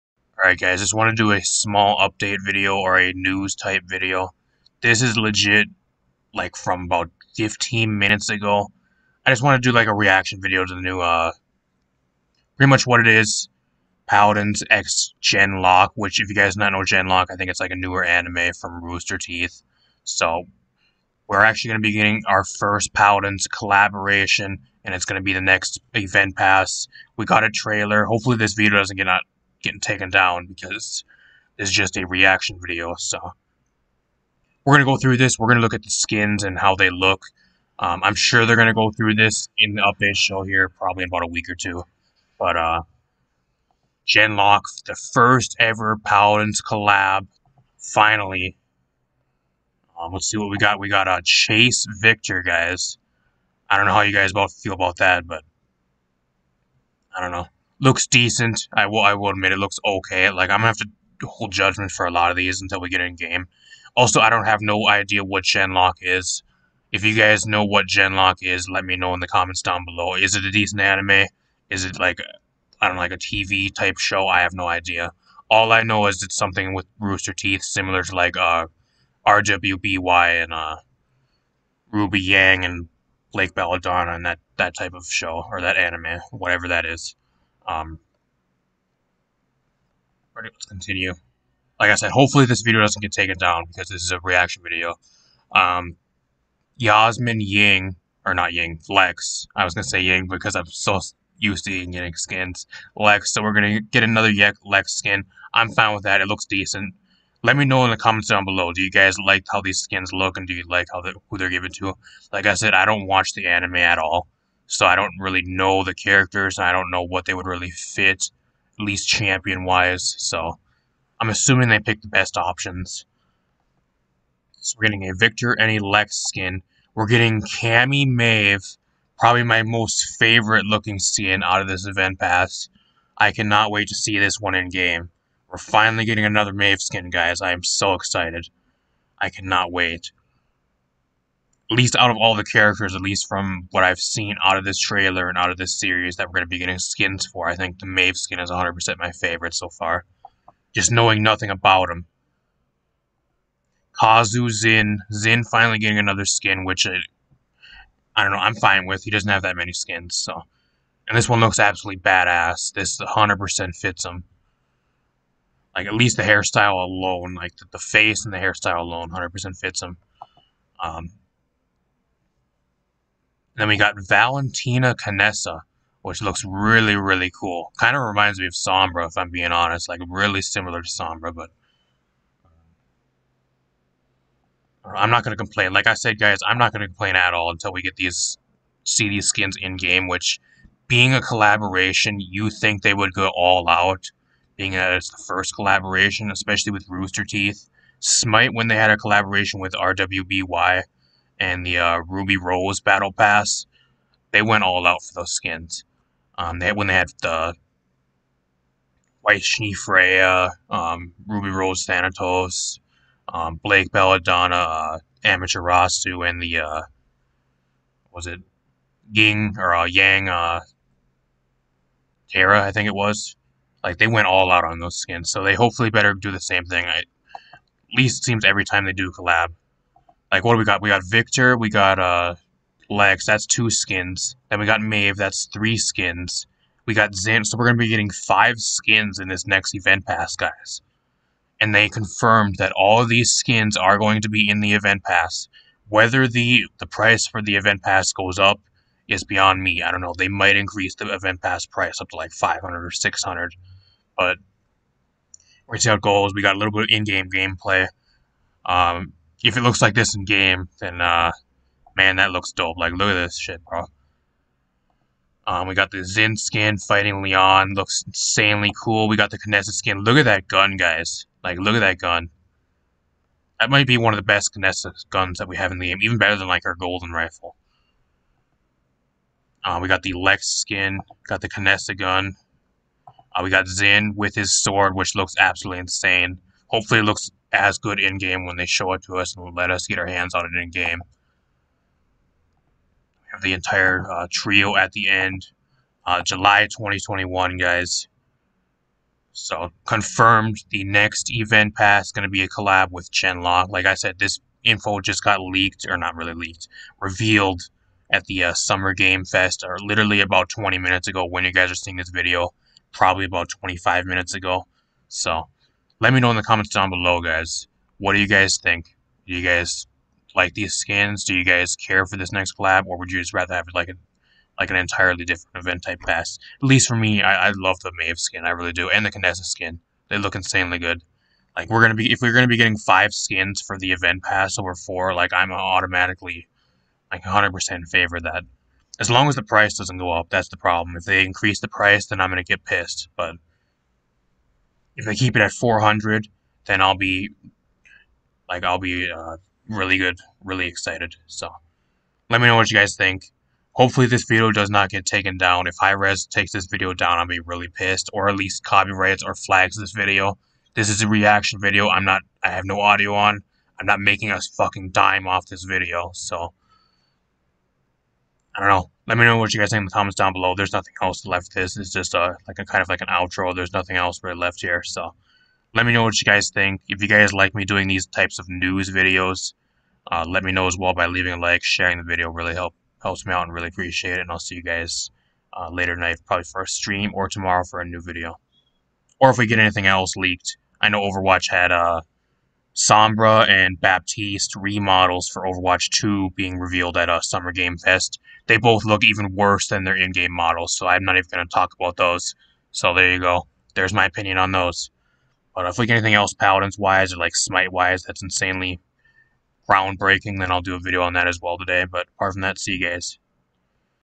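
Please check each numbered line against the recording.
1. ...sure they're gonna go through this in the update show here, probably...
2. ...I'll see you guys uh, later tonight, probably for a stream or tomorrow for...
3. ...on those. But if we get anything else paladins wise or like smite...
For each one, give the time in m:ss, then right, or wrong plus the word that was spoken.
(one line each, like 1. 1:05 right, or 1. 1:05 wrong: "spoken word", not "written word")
1. 0:38 right
2. 6:24 right
3. 6:44 right.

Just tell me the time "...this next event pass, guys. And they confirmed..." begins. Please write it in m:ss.
3:59.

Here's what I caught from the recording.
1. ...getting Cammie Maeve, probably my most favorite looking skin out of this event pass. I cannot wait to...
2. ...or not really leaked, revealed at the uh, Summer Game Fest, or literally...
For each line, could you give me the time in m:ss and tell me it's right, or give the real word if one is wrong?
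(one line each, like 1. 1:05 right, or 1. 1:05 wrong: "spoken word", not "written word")
1. 2:07 right
2. 5:05 right.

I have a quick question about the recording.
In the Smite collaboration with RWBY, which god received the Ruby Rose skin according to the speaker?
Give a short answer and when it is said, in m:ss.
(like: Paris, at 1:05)
Thanatos, at 3:31.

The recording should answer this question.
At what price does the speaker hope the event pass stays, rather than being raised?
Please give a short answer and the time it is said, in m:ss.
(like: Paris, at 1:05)
400, at 5:45.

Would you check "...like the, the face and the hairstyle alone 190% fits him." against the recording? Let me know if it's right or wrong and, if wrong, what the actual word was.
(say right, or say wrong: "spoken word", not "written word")
wrong: "100", not "190".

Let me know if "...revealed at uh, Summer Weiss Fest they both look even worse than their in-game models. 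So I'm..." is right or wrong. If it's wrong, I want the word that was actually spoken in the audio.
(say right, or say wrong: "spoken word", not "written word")
wrong: "Game", not "Weiss".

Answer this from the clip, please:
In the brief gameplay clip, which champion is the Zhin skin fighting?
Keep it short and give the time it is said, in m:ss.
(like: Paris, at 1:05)
Lian, at 4:27.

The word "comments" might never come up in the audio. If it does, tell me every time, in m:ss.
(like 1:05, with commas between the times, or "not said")
1:09, 1:47, 5:16, 6:09.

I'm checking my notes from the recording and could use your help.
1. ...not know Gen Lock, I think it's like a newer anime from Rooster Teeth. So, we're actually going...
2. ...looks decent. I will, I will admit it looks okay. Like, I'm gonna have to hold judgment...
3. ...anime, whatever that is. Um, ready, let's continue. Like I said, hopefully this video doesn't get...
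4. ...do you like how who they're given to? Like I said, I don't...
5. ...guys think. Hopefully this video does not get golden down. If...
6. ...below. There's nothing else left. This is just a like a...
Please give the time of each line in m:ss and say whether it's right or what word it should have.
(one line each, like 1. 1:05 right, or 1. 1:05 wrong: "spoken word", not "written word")
1. 0:16 right
2. 0:57 right
3. 1:25 right
4. 1:50 right
5. 5:52 wrong: "taken", not "golden"
6. 6:10 right.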